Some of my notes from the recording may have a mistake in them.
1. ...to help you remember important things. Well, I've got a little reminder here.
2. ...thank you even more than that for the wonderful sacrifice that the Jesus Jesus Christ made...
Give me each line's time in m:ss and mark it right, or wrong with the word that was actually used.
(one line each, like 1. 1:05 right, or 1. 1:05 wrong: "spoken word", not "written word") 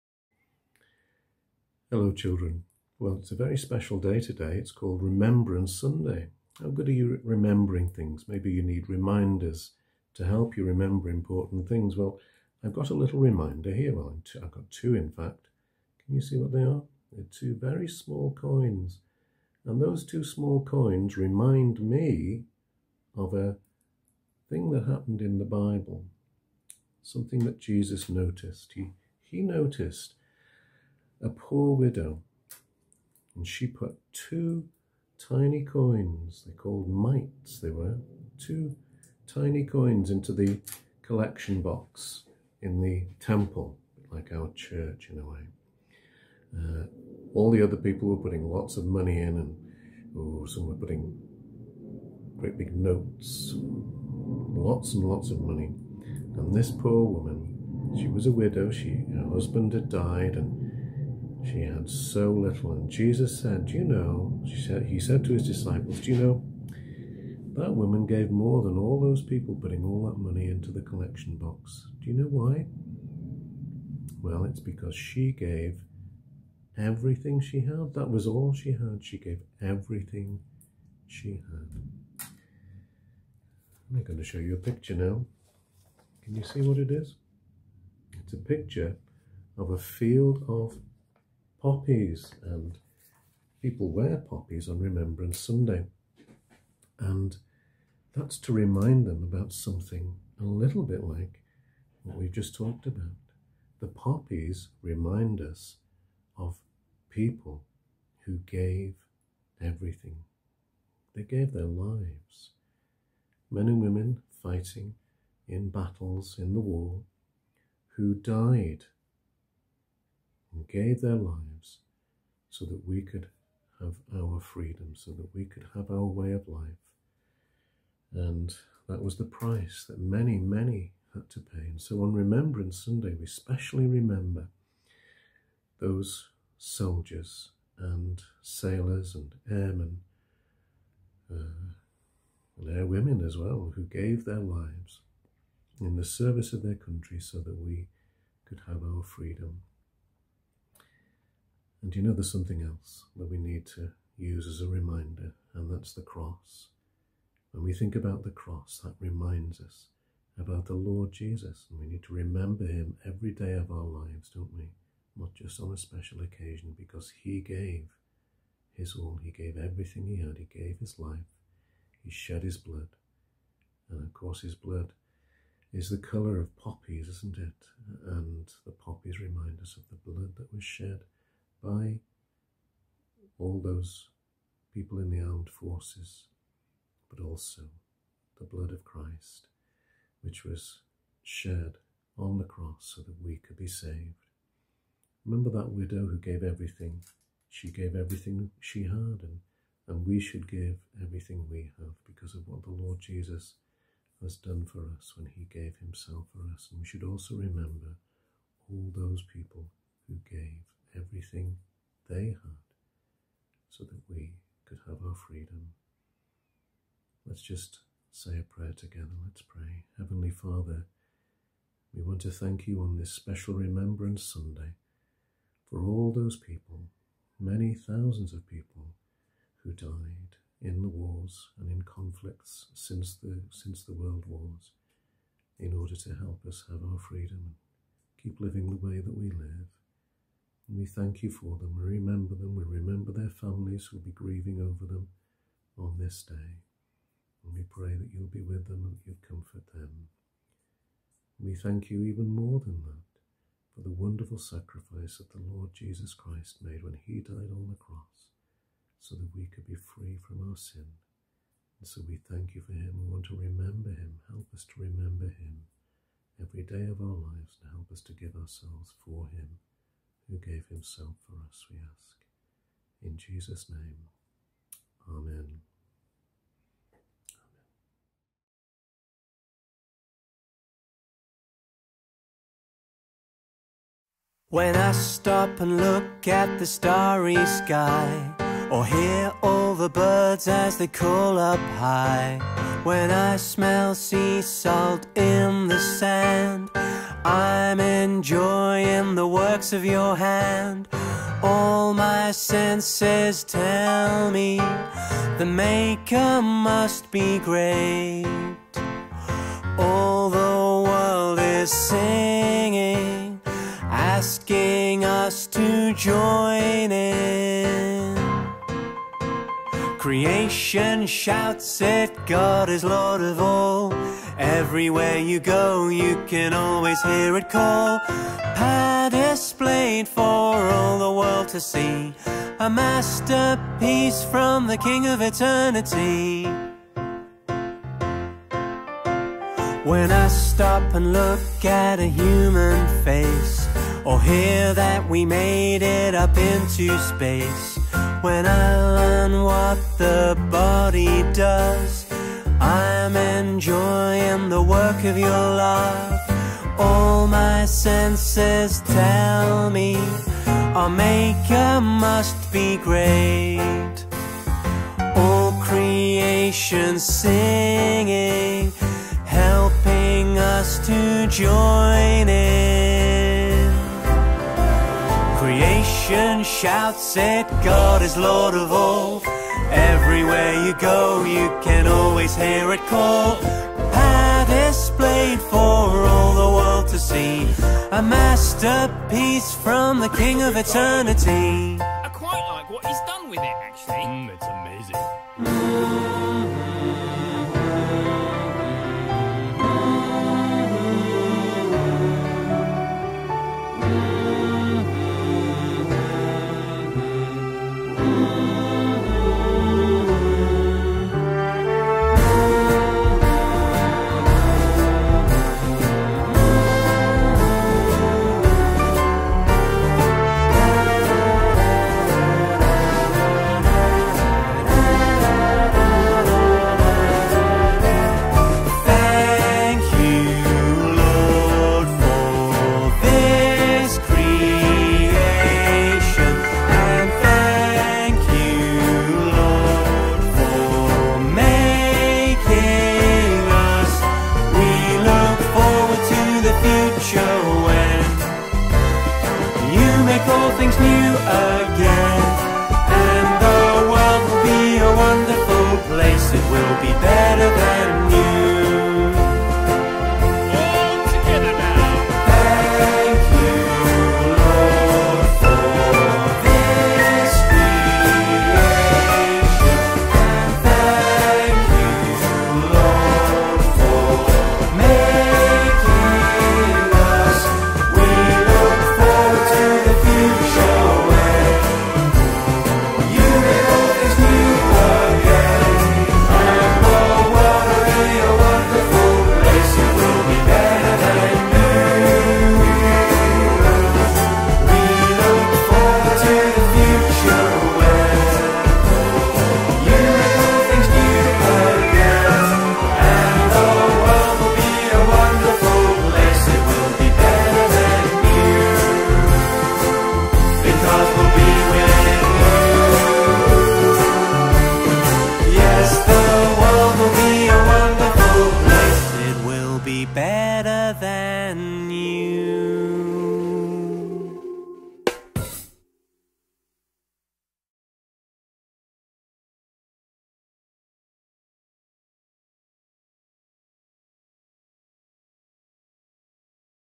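1. 0:10 right
2. 4:11 wrong: "Lord", not "Jesus".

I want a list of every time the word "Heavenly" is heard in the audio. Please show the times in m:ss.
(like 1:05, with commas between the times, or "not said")
3:39.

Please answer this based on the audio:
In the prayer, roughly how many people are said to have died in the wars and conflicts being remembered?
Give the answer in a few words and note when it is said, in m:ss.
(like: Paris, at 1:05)
many thousands, at 3:47.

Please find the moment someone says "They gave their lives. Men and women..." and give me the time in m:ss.
1:51.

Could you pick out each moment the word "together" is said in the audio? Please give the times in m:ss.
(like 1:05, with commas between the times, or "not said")
3:38.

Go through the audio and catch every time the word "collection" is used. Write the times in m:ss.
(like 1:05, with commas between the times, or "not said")
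0:41, 1:10.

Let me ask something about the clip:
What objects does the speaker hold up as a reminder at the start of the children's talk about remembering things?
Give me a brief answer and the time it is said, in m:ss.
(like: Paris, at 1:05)
two very small coins, at 0:17.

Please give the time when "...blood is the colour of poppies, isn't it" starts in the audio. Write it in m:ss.
2:54.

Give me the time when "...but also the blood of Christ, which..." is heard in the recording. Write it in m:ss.
3:07.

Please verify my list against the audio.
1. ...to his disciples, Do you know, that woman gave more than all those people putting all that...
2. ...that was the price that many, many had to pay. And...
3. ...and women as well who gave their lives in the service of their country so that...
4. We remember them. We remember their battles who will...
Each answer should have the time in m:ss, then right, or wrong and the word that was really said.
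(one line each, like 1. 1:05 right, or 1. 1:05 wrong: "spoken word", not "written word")
1. 1:05 right
2. 2:08 right
3. 2:22 right
4. 4:01 wrong: "families", not "battles".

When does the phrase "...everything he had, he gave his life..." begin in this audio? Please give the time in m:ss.
2:49.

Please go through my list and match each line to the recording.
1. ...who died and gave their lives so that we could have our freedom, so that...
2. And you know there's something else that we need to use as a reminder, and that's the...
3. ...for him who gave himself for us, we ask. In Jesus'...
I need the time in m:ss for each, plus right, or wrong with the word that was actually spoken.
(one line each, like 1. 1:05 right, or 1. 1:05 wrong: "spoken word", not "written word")
1. 1:57 right
2. 2:31 right
3. 4:29 right.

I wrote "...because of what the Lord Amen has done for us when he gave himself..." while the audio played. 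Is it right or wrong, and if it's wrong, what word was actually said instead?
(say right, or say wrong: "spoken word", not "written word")
wrong: "Jesus", not "Amen".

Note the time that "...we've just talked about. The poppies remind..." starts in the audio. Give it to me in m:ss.
1:42.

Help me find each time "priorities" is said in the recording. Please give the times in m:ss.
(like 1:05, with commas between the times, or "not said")
not said.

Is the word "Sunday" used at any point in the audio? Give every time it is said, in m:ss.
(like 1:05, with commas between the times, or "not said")
0:05, 1:35, 2:12, 3:44.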